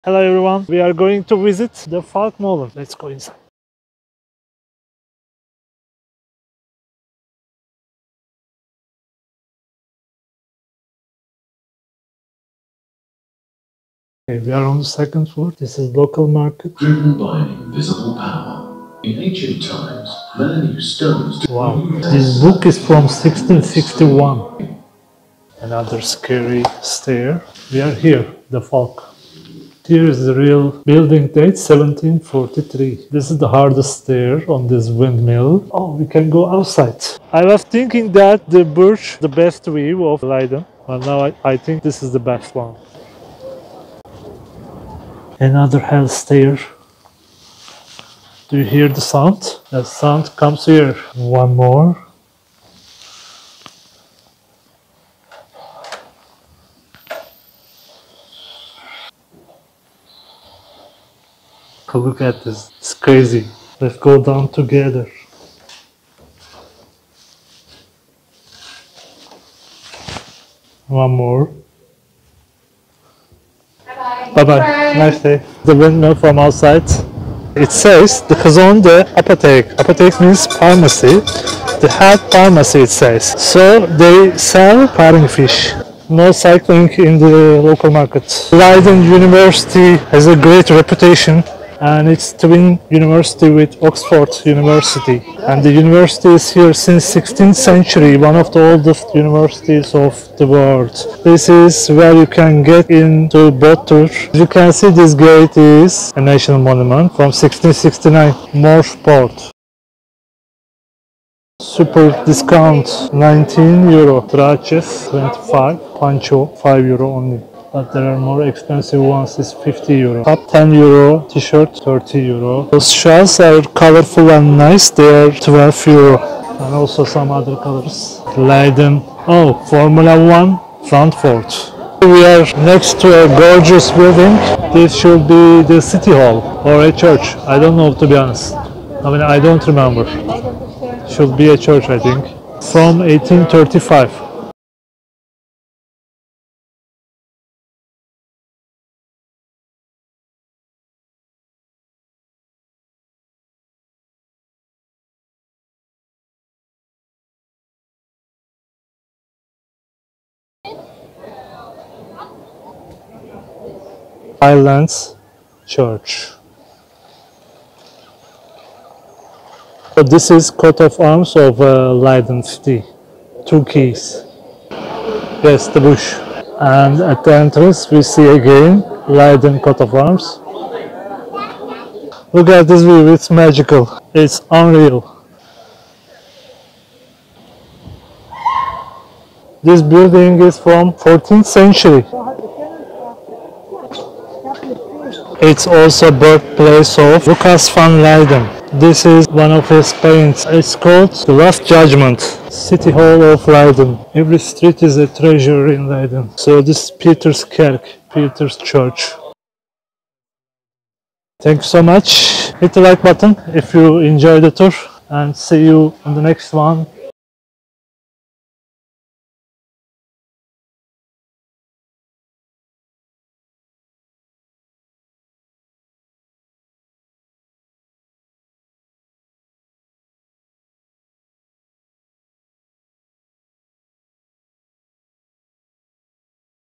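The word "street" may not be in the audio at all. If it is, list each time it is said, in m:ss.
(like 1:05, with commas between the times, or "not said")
3:24.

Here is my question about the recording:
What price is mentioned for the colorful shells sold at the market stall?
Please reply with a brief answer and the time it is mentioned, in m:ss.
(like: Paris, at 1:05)
12 euro, at 2:05.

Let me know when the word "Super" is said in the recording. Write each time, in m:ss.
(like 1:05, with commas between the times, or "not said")
1:51.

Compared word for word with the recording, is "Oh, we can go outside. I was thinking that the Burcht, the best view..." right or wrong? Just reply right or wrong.
right.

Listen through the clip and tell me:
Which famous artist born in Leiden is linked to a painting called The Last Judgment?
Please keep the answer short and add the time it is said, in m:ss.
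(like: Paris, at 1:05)
Lucas van Leiden, at 3:17.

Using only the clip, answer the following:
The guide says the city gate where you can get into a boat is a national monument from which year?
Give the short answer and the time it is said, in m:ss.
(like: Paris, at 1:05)
1669, at 1:47.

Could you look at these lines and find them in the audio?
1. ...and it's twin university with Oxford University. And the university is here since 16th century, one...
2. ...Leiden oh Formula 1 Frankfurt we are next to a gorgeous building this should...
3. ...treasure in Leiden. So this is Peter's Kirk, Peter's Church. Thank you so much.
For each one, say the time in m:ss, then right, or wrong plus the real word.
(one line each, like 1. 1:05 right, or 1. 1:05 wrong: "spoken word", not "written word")
1. 1:31 right
2. 2:08 right
3. 3:25 right.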